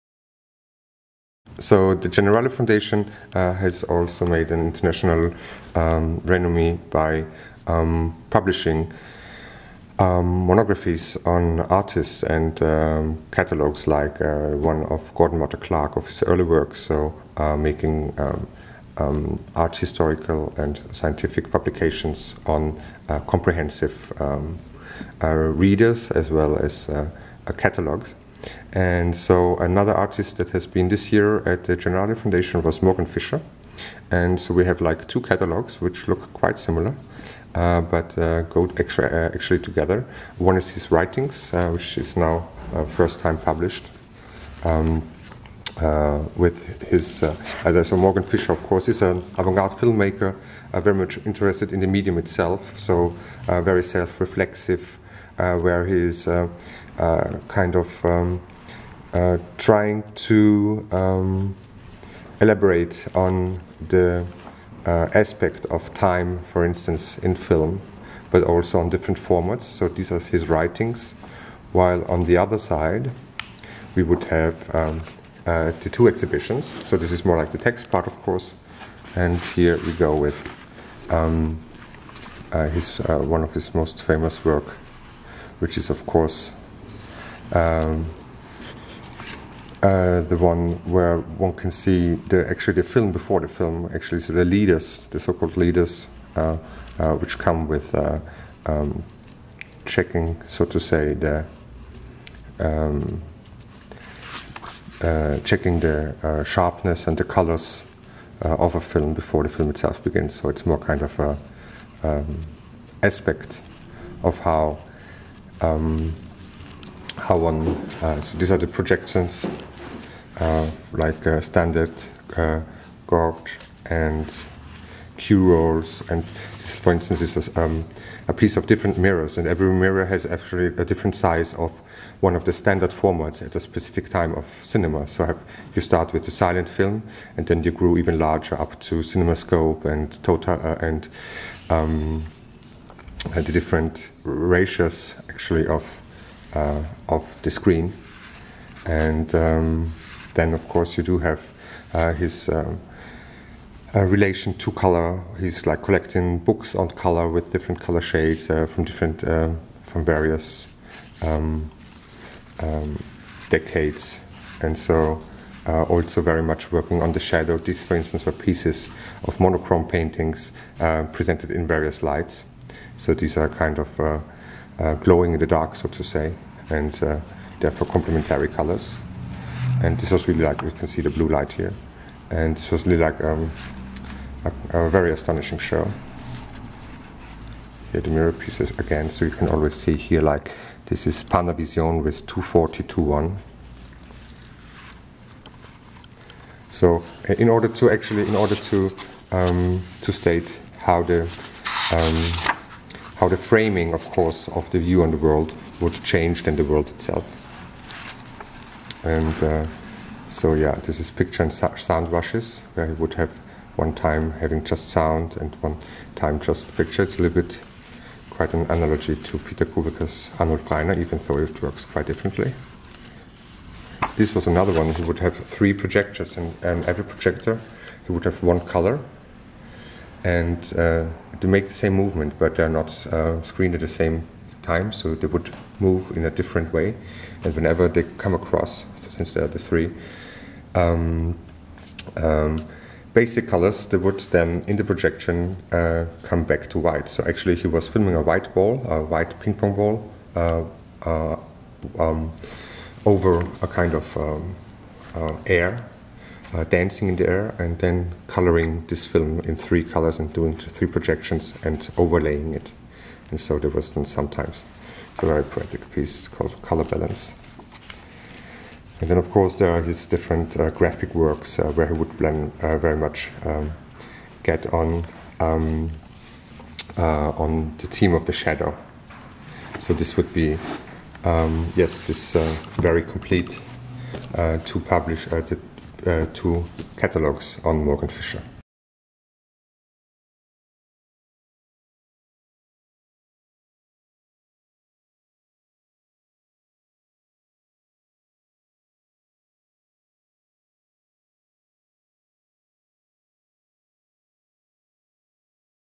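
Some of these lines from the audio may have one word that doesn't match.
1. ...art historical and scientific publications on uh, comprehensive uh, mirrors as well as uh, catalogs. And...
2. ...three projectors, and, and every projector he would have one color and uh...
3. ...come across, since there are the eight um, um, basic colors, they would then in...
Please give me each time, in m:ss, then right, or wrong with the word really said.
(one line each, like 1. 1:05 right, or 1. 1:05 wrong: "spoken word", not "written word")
1. 0:19 wrong: "readers", not "mirrors"
2. 3:45 right
3. 3:58 wrong: "three", not "eight".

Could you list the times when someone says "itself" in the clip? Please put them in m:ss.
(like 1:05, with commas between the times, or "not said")
0:52, 1:49, 3:26.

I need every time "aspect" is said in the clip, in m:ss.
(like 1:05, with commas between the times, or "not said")
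1:04, 1:53.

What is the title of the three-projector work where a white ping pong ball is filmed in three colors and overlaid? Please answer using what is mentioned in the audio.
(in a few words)
Color Balance.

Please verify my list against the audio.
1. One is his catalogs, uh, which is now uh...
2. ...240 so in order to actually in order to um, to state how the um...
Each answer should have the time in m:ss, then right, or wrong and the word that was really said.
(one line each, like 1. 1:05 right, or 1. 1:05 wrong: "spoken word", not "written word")
1. 0:40 wrong: "writings", not "catalogs"
2. 3:12 right.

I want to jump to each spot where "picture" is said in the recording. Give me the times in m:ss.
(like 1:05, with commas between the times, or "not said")
3:31, 3:36.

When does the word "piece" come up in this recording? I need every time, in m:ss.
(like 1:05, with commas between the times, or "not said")
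2:08, 2:48, 3:08, 4:25.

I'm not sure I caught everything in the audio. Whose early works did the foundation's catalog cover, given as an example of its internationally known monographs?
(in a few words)
Gordon Matta-Clark.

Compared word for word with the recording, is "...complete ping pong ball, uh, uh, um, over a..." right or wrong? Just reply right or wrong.
wrong.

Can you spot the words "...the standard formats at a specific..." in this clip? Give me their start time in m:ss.
2:12.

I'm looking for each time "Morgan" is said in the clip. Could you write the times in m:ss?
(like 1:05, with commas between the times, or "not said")
0:32, 0:47, 4:47.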